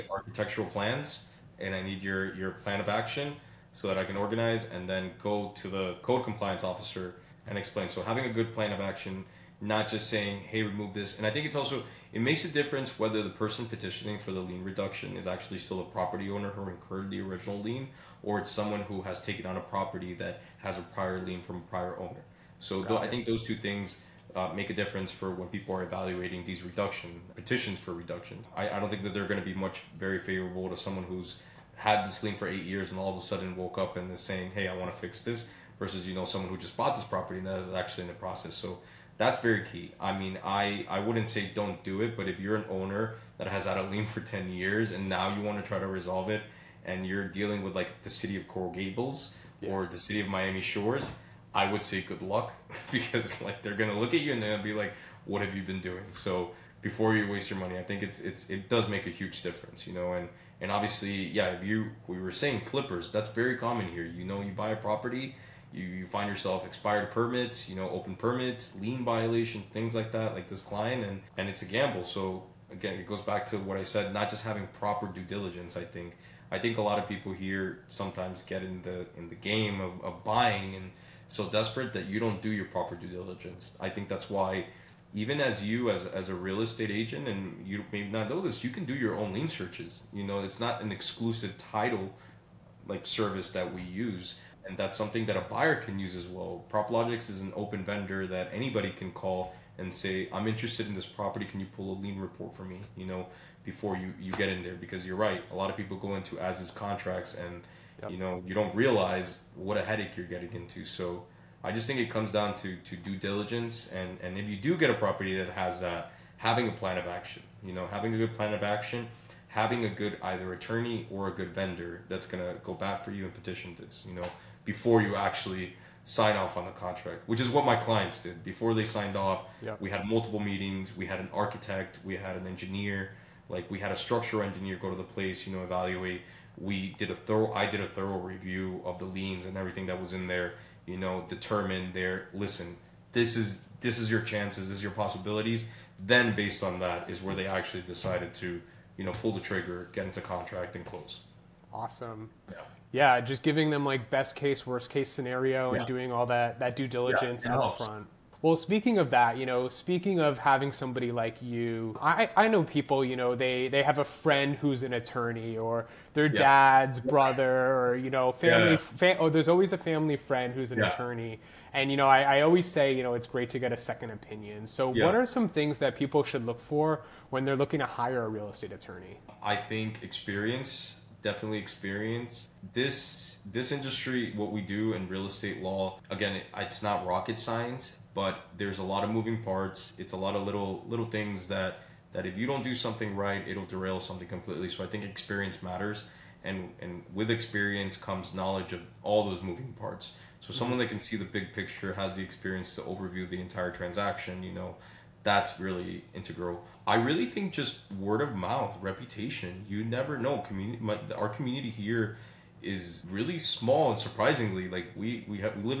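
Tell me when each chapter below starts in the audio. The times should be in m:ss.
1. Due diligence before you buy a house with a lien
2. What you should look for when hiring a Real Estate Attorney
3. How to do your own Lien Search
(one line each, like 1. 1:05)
1. 2:00
2. 2:55
3. 1:27.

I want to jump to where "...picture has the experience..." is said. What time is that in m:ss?
3:21.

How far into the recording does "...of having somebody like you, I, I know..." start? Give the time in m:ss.
2:40.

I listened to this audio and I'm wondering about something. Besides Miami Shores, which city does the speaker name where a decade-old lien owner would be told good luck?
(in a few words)
Coral Gables.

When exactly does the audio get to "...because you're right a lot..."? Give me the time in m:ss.
1:44.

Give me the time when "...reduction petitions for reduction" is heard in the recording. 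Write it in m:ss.
0:26.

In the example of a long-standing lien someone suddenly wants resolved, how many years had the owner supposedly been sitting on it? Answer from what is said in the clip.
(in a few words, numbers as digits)
8.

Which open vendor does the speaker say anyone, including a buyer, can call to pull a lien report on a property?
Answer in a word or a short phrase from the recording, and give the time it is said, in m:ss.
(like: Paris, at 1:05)
Proplogix, at 1:36.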